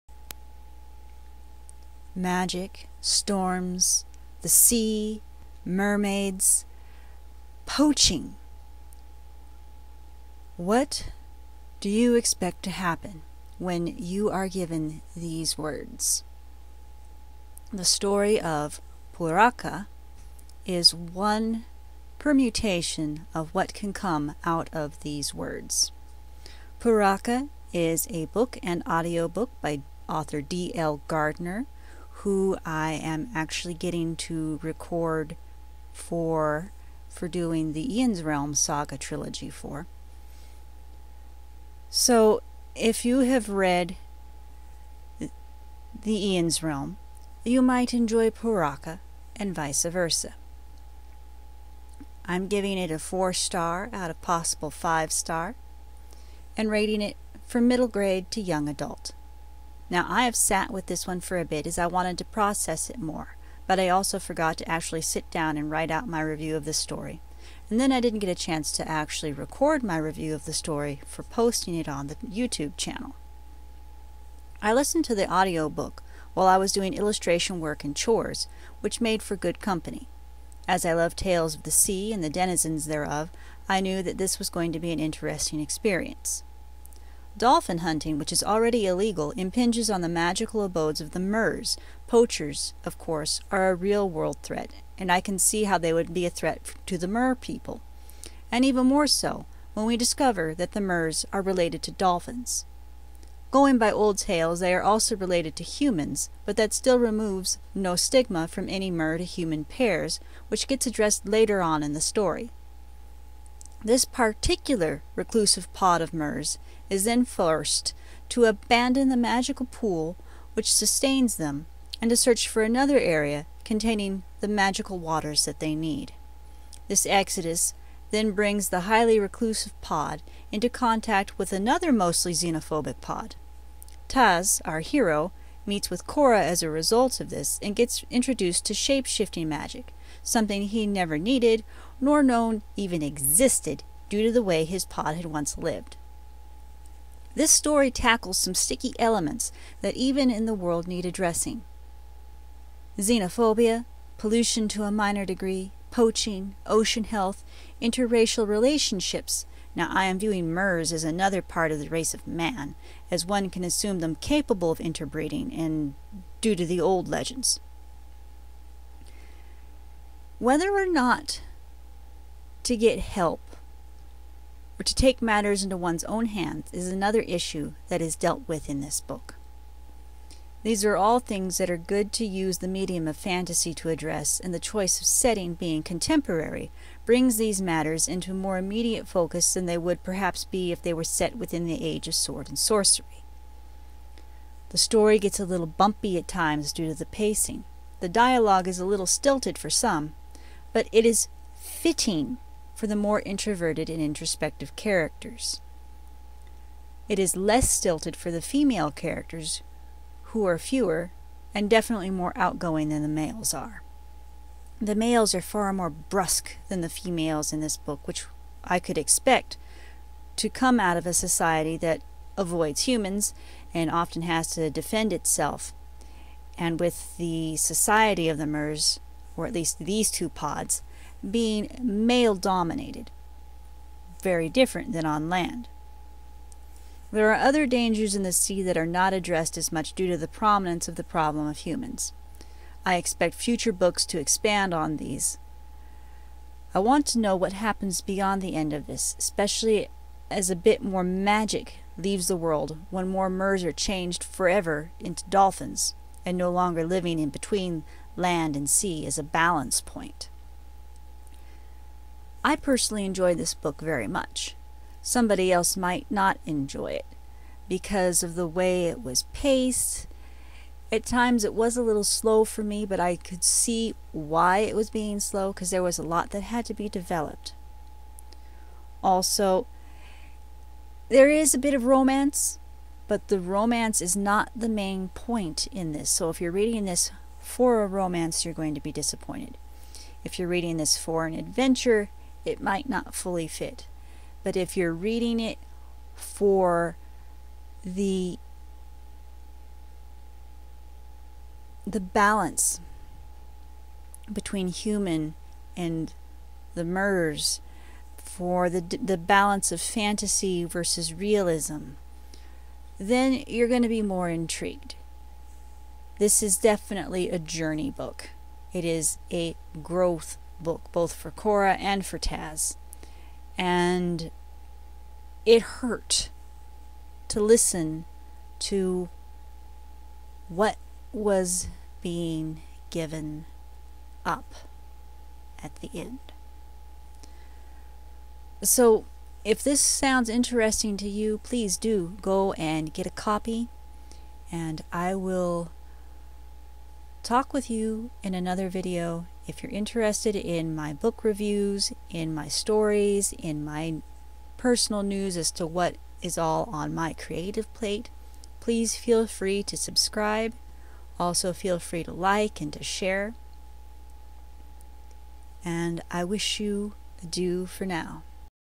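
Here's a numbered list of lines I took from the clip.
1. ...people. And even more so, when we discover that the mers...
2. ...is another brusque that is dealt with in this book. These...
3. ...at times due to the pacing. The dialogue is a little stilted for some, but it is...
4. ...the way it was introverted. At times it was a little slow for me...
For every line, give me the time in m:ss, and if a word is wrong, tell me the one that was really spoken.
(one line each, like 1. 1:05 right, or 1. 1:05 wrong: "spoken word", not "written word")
1. 1:37 right
2. 2:56 wrong: "issue", not "brusque"
3. 3:16 right
4. 4:28 wrong: "paced", not "introverted".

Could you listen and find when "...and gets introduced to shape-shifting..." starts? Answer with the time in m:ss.
2:17.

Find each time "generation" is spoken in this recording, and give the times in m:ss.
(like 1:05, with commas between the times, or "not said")
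not said.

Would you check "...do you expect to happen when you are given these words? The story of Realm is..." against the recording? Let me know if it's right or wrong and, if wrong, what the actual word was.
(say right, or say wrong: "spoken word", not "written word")
wrong: "Pouraka", not "Realm".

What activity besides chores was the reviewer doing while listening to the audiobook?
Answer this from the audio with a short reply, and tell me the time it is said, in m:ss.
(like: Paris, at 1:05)
Illustration work, at 1:16.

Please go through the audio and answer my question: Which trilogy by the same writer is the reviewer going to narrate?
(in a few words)
Ian's Realm Saga.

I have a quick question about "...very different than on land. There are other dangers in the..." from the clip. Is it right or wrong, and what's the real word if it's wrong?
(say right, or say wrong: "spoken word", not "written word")
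right.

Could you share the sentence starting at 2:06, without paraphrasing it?
This exodus then brings the highly reclusive pod into contact with another mostly xenophobic pod.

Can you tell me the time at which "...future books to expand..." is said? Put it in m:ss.
4:03.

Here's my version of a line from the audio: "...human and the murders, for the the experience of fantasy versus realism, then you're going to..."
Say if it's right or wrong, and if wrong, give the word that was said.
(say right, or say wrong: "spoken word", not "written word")
wrong: "balance", not "experience".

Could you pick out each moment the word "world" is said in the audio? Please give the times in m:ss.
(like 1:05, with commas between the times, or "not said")
1:34, 2:30, 4:12.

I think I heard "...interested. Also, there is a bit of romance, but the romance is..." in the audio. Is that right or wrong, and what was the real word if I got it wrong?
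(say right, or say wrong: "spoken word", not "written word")
wrong: "developed", not "interested".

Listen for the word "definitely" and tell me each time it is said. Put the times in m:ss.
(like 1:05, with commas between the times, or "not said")
3:31, 5:16.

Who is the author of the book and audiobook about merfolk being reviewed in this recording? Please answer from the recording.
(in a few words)
D.L. Gardner.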